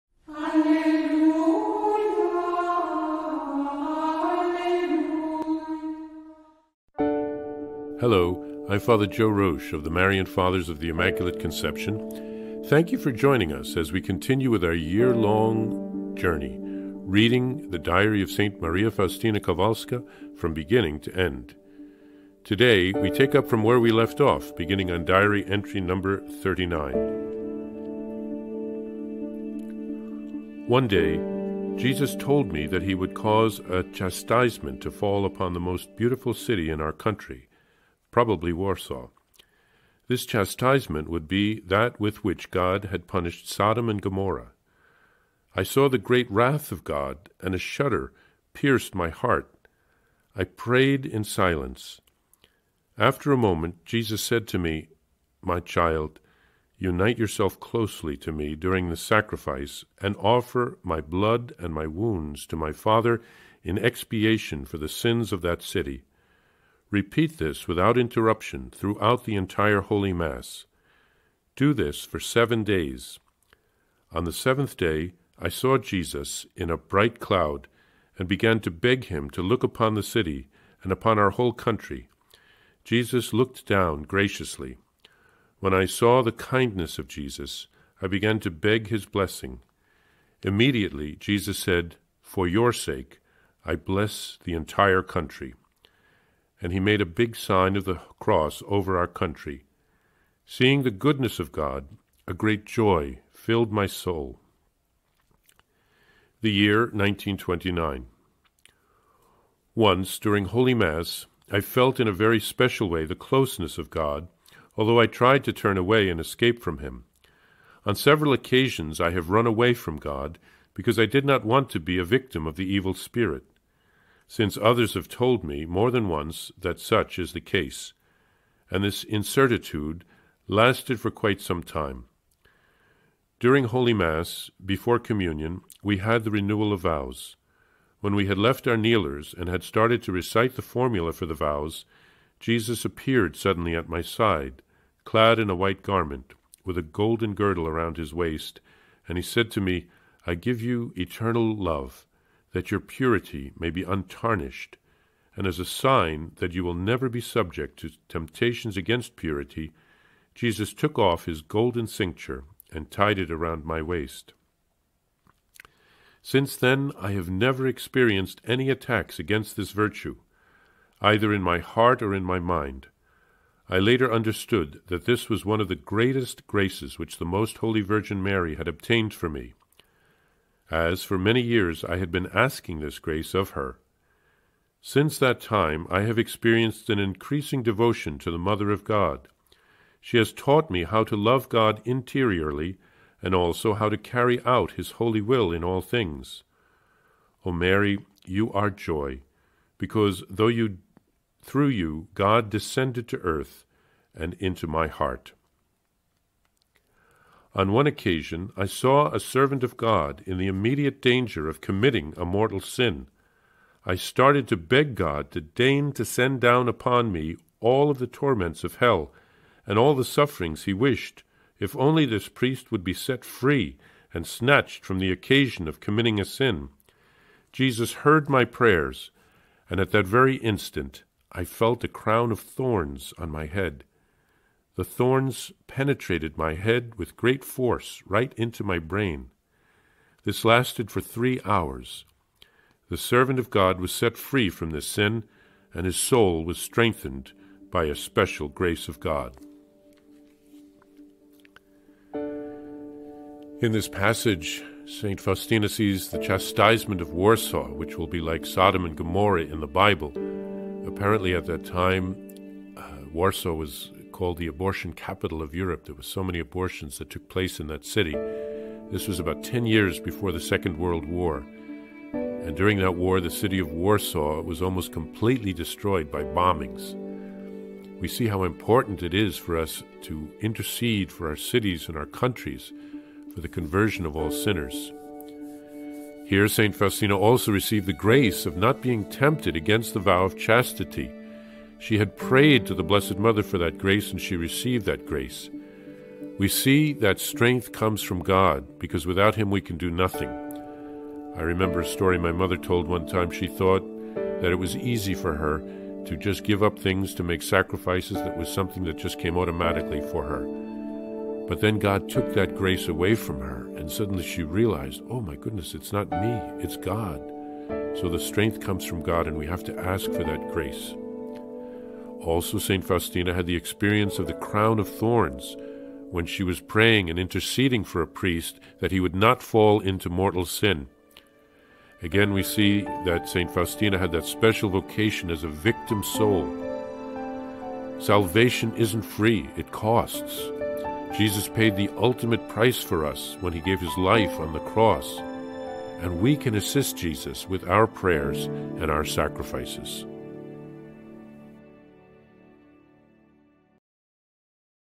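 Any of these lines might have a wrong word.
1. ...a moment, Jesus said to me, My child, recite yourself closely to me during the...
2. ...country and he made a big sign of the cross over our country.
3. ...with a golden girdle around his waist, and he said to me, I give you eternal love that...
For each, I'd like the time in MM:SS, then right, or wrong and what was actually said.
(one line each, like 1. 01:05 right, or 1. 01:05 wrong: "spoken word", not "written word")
1. 00:53 wrong: "unite", not "recite"
2. 01:35 right
3. 02:26 right.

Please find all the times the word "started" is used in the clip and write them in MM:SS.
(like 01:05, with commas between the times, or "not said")
02:19, 03:33.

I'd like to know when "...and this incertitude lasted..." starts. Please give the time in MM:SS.
02:08.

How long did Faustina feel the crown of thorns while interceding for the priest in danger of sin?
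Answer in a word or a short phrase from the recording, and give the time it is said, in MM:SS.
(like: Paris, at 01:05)
3 hours, at 04:01.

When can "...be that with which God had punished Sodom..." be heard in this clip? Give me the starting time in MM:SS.
00:41.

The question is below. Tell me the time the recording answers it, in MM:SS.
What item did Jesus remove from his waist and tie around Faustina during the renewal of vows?
02:41.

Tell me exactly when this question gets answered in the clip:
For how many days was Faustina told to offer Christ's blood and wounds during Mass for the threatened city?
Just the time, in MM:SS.
01:12.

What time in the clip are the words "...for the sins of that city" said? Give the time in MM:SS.
01:04.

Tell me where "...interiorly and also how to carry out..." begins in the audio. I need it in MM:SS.
03:11.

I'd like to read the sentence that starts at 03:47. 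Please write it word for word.
Jesus heard my prayers, and at that very instant I felt a crown of thorns on my head.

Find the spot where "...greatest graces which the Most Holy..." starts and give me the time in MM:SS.
02:55.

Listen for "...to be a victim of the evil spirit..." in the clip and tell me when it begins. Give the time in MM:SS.
02:01.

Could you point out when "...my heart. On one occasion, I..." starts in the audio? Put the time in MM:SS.
03:24.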